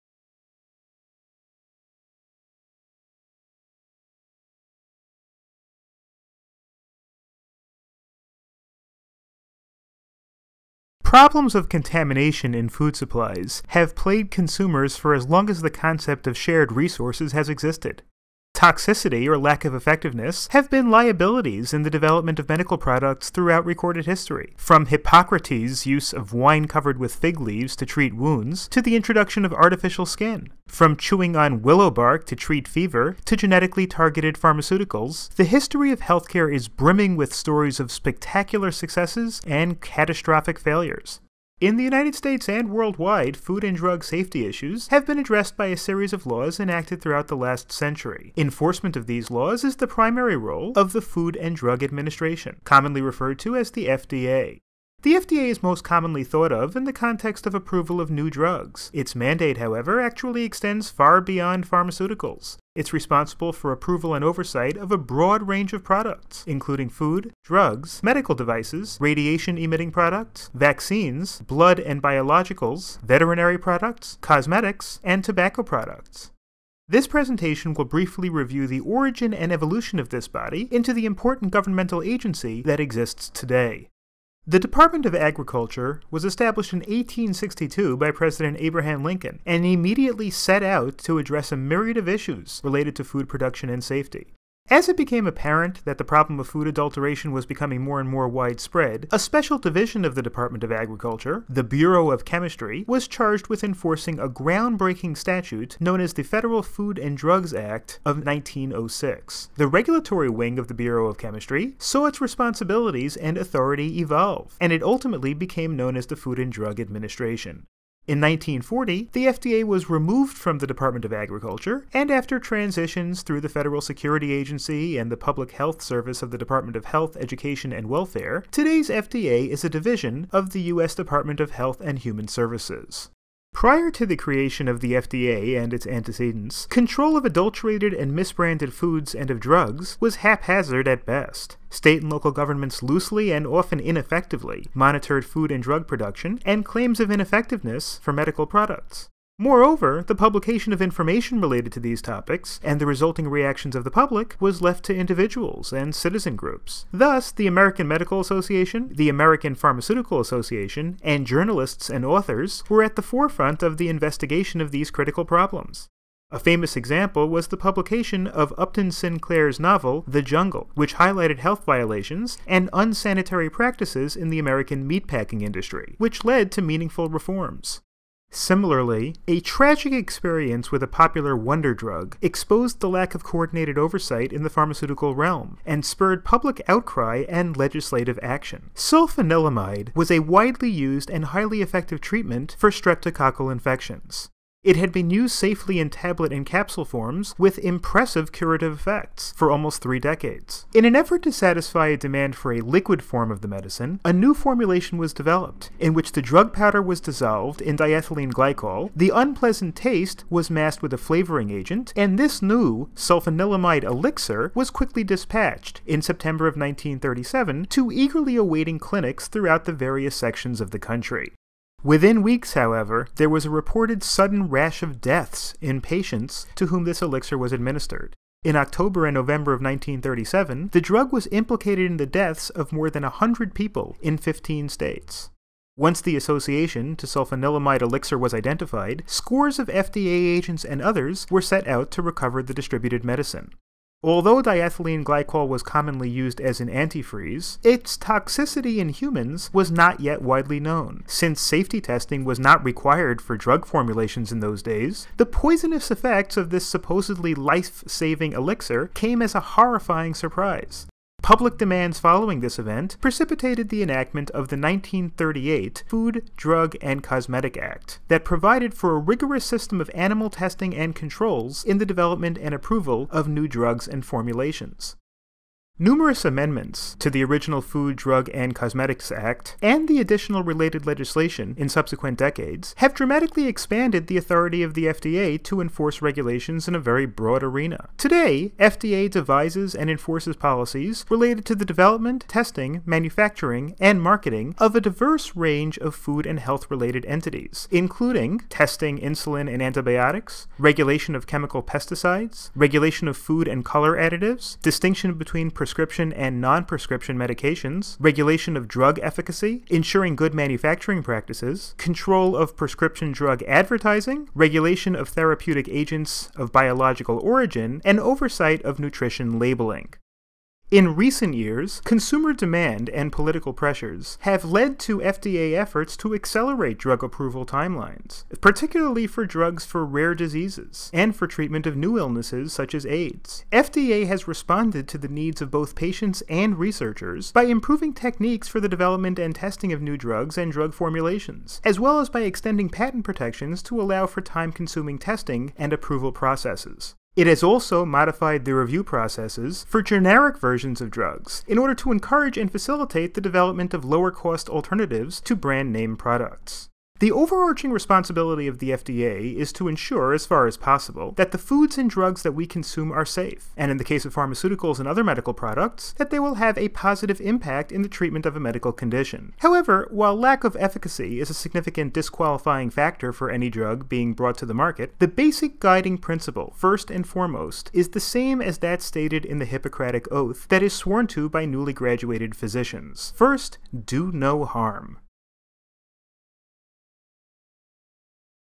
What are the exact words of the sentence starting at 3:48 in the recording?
In October and November of 1937, the drug was implicated in the deaths of more than 100 people in 15 states.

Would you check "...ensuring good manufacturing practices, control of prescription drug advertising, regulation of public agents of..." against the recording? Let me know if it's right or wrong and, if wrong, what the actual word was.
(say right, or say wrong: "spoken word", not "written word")
wrong: "therapeutic", not "public".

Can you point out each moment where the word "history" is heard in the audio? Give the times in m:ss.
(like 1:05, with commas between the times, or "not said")
0:24, 0:35.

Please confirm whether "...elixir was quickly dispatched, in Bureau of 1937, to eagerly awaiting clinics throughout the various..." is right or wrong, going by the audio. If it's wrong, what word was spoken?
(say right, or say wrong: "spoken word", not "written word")
wrong: "September", not "Bureau".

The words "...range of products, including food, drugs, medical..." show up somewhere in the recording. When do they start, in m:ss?
1:05.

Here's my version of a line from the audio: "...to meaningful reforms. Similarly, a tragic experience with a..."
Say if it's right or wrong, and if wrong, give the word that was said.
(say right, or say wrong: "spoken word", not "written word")
right.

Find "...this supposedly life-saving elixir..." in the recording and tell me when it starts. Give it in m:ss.
4:16.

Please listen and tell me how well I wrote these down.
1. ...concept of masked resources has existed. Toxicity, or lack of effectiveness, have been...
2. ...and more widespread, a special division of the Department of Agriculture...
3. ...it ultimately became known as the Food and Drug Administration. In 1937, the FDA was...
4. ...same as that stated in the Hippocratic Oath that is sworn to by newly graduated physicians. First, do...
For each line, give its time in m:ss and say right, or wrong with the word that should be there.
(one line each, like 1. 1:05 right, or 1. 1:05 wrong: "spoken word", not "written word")
1. 0:15 wrong: "shared", not "masked"
2. 1:37 right
3. 1:54 wrong: "1940", not "1937"
4. 6:17 right.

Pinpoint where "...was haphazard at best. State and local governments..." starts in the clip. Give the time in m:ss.
2:19.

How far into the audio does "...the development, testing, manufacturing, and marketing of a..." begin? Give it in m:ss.
4:51.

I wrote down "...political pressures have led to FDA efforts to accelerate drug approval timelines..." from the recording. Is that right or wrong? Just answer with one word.
right.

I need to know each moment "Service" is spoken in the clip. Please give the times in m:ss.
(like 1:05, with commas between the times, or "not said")
2:05, 2:12.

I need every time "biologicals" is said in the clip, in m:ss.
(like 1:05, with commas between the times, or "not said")
1:12, 5:16.